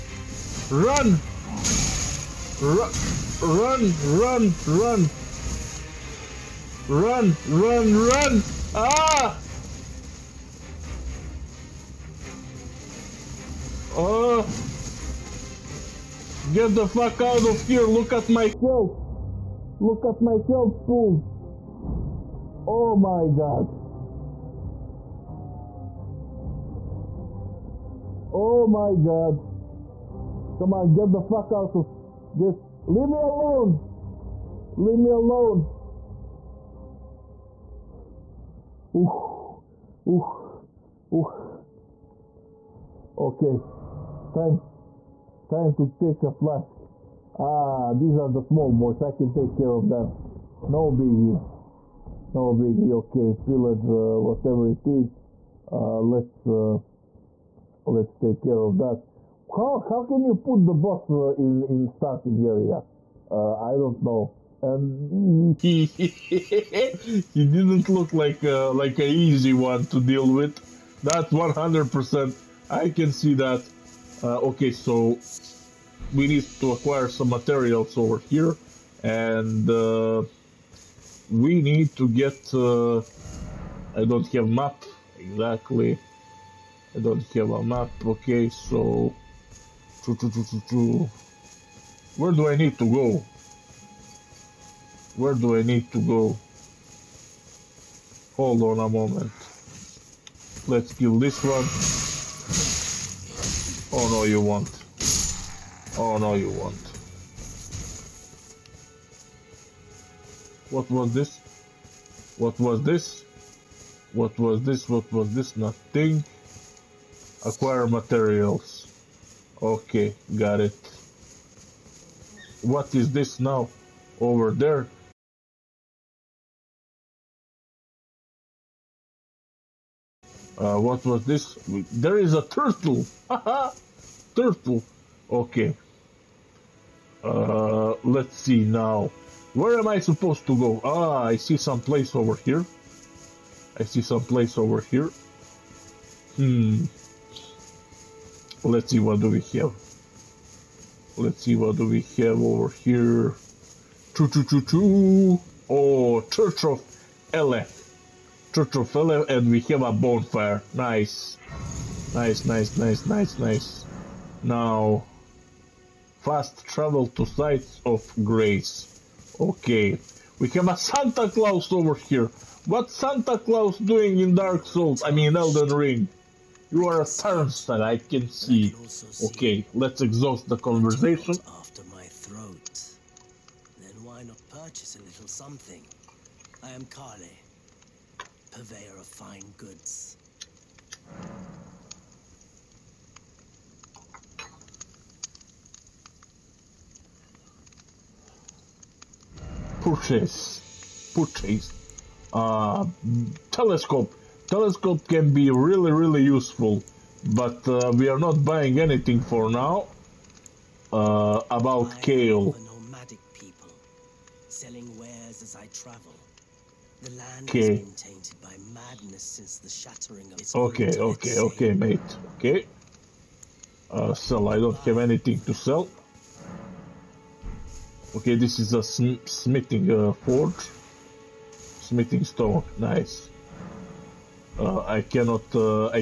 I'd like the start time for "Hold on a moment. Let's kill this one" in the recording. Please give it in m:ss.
1:38.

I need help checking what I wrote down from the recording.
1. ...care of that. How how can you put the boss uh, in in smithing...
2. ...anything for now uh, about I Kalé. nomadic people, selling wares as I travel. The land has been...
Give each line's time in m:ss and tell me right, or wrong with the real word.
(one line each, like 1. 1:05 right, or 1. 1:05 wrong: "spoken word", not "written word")
1. 0:58 wrong: "starting", not "smithing"
2. 3:28 right.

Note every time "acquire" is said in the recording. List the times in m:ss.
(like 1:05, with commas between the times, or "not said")
1:16, 1:57.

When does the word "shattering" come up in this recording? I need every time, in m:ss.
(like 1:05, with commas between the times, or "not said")
3:39.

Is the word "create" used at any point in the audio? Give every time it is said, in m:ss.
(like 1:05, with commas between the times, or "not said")
not said.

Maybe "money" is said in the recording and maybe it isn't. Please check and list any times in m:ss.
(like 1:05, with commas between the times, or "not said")
not said.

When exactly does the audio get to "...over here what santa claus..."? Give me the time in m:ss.
2:51.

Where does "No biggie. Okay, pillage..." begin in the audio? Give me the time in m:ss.
0:52.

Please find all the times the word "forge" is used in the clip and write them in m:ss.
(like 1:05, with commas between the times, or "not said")
3:50.